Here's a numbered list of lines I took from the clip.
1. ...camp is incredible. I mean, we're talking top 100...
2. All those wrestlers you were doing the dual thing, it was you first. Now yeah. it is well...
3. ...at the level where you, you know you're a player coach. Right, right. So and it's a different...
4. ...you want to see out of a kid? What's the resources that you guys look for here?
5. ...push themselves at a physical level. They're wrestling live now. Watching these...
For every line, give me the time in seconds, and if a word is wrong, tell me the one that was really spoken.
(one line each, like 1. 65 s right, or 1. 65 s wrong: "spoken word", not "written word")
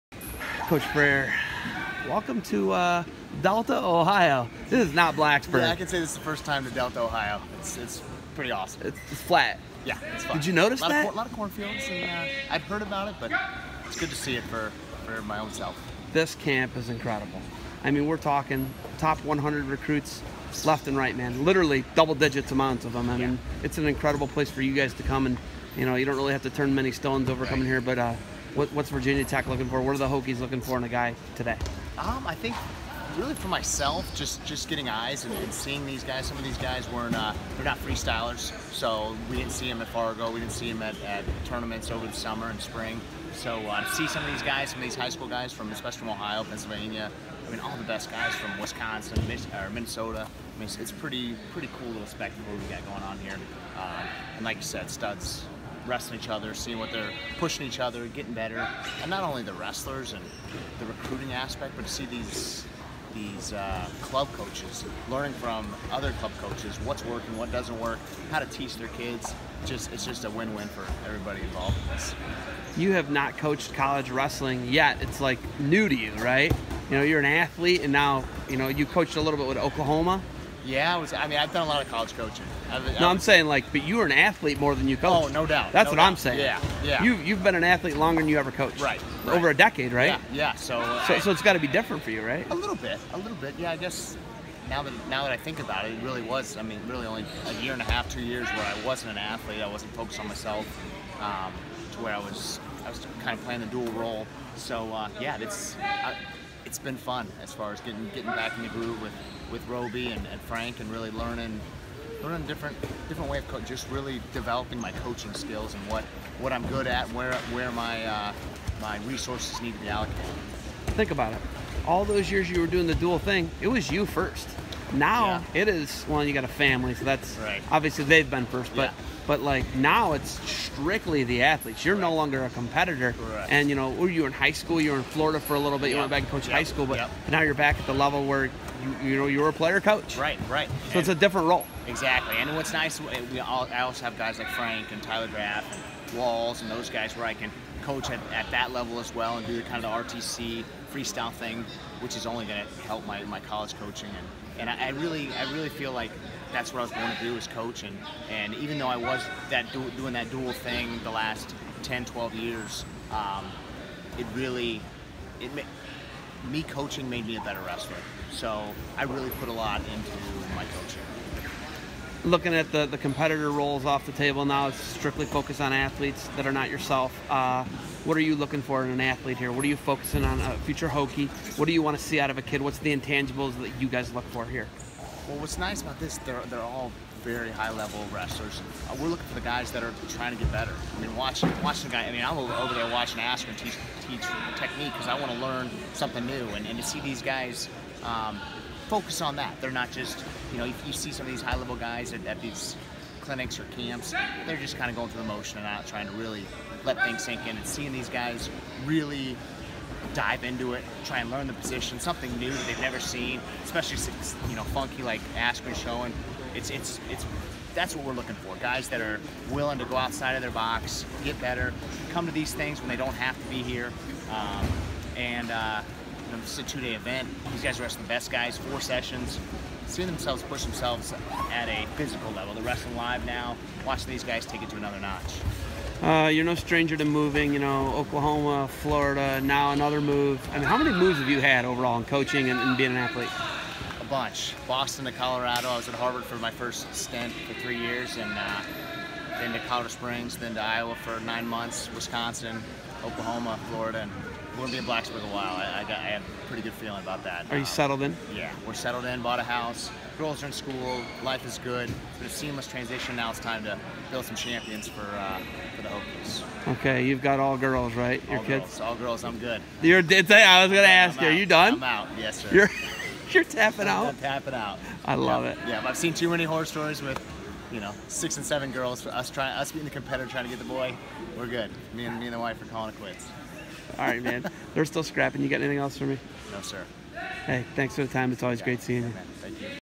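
1. 16 s right
2. 121 s wrong: "years", not "wrestlers"
3. 137 s right
4. 181 s wrong: "intangibles", not "resources"
5. 230 s right.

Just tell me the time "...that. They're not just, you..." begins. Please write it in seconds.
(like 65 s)
199 s.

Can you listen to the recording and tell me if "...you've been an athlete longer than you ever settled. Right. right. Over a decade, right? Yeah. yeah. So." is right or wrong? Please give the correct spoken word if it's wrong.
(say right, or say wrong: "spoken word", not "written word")
wrong: "coached", not "settled".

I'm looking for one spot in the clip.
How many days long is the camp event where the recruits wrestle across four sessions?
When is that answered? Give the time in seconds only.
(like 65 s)
226 s.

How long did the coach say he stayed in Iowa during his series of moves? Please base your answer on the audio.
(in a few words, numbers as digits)
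9 months.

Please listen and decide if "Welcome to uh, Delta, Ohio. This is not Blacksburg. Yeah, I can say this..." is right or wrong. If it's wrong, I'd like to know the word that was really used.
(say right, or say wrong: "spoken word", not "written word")
right.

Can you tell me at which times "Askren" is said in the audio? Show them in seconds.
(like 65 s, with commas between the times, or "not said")
193 s, 215 s.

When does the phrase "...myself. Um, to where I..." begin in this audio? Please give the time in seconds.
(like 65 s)
100 s.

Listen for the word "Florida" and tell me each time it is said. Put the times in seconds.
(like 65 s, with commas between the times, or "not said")
135 s, 238 s, 253 s.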